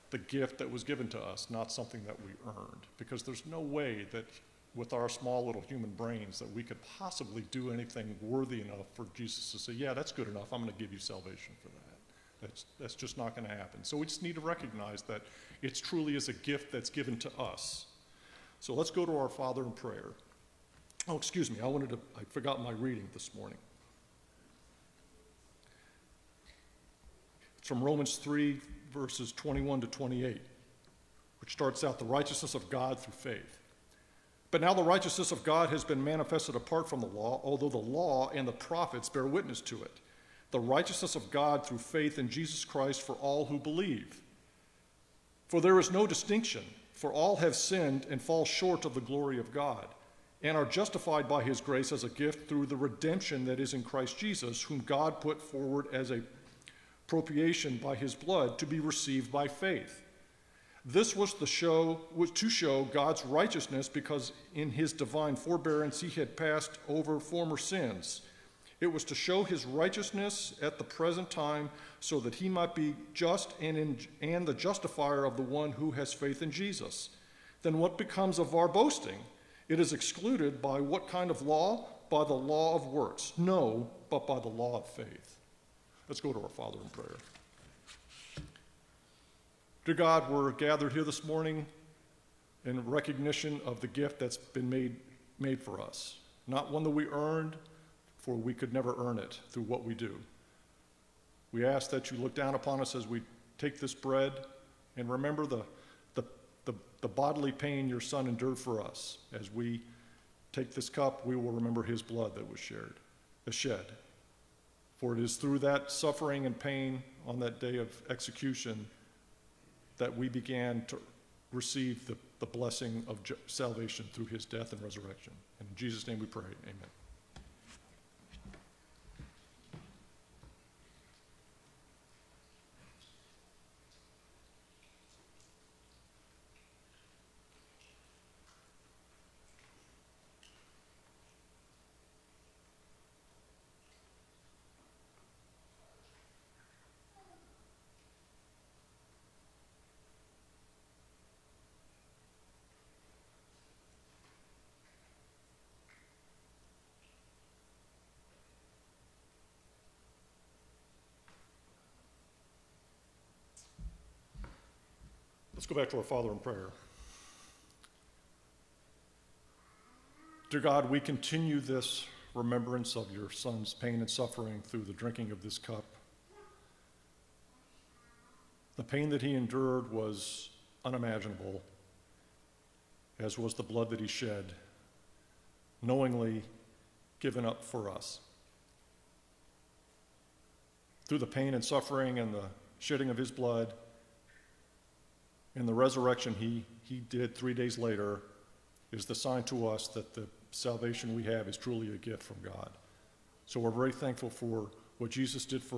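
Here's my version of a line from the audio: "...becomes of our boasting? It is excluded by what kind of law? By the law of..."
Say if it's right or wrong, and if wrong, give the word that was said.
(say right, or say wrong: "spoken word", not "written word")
right.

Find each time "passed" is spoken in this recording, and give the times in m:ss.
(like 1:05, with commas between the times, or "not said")
1:06.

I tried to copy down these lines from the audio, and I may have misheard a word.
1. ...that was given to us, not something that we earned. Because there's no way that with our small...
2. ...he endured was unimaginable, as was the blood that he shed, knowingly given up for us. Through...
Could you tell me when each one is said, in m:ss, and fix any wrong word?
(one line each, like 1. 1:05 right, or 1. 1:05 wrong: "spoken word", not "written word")
1. 0:00 right
2. 2:59 right.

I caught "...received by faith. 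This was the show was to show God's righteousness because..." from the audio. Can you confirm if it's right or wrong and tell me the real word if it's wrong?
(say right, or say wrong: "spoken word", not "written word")
right.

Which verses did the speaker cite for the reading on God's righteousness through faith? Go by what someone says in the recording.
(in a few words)
21 to 28.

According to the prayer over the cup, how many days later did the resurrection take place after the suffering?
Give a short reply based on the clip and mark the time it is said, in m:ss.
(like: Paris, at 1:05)
3 days, at 3:17.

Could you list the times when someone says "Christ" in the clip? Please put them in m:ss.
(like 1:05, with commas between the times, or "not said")
0:42, 0:53.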